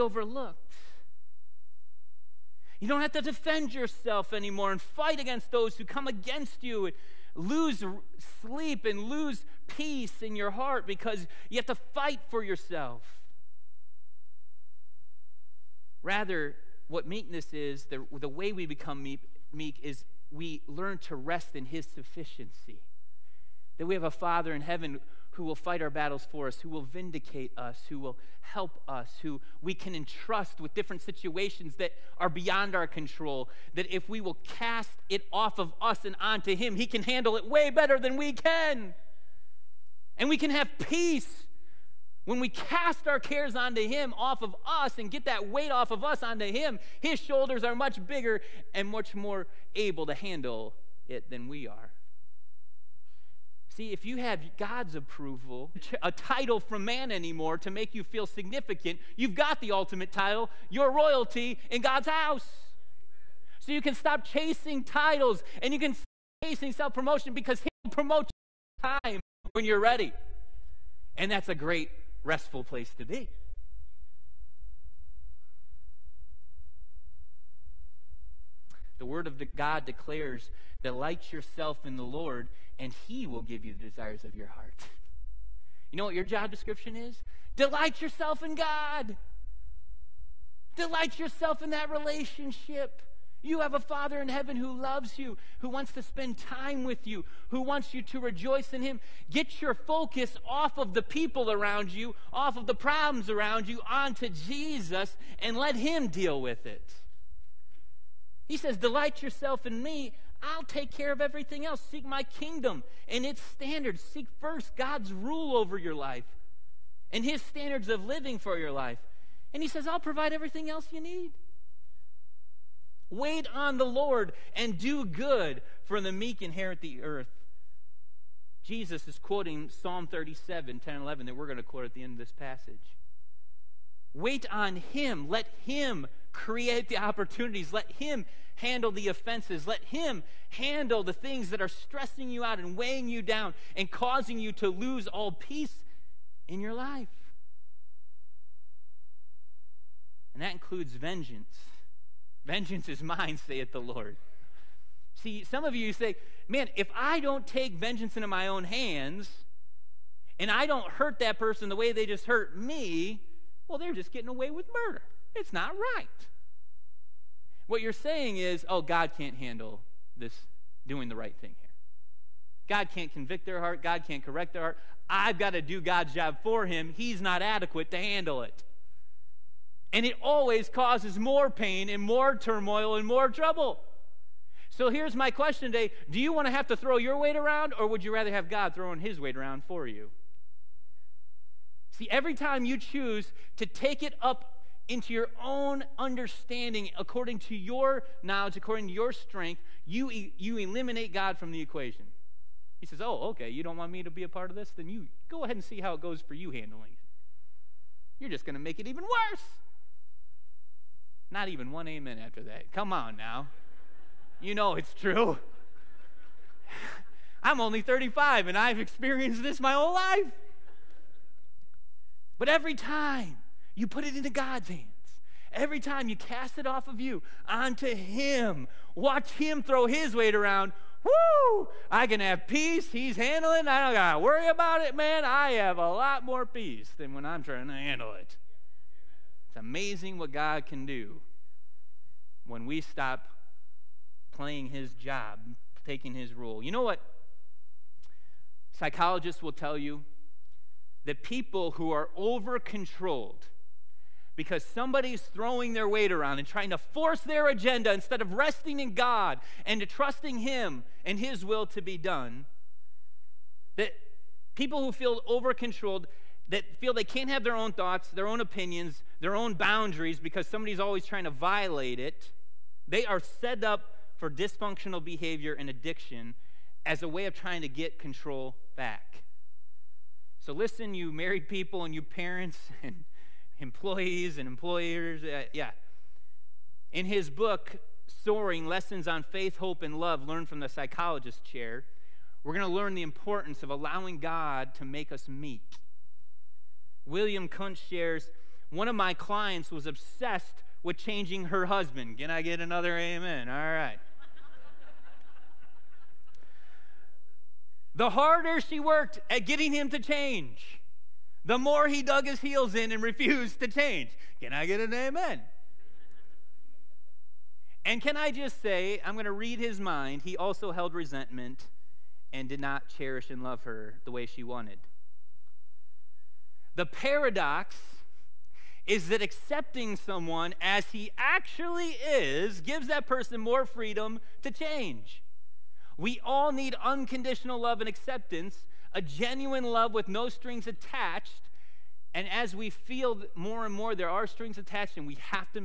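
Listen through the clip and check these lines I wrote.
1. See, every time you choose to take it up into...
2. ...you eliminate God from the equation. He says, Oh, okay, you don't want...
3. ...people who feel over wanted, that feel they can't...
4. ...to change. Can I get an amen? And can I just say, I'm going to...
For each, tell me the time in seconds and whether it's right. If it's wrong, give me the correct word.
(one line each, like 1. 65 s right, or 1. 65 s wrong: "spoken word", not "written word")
1. 191 s right
2. 200 s right
3. 264 s wrong: "controlled", not "wanted"
4. 313 s right.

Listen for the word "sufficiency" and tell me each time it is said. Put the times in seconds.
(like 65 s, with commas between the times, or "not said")
21 s.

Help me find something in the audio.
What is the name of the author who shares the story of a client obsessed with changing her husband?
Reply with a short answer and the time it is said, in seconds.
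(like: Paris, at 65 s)
William Kunst, at 297 s.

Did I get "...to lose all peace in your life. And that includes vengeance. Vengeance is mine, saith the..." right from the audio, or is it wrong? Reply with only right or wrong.
right.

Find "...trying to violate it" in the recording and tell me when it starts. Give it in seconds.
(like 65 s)
271 s.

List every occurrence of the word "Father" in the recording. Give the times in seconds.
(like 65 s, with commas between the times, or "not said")
24 s, 93 s.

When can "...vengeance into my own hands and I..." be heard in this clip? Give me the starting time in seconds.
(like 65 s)
157 s.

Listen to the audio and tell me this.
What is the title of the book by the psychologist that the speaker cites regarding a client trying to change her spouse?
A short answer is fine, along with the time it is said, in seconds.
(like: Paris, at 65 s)
Soaring Lessons on Faith, Hope, and Love, at 288 s.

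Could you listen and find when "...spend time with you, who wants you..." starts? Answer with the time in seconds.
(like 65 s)
96 s.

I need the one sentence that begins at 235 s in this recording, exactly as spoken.
I have a lot more peace than when I'm trying to handle it.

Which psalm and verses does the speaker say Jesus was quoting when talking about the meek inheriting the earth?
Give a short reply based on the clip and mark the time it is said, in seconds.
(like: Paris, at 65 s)
Psalm 37:10-11, at 129 s.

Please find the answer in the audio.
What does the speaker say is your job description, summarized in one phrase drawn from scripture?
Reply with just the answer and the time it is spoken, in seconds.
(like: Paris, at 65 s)
Delight yourself in God, at 87 s.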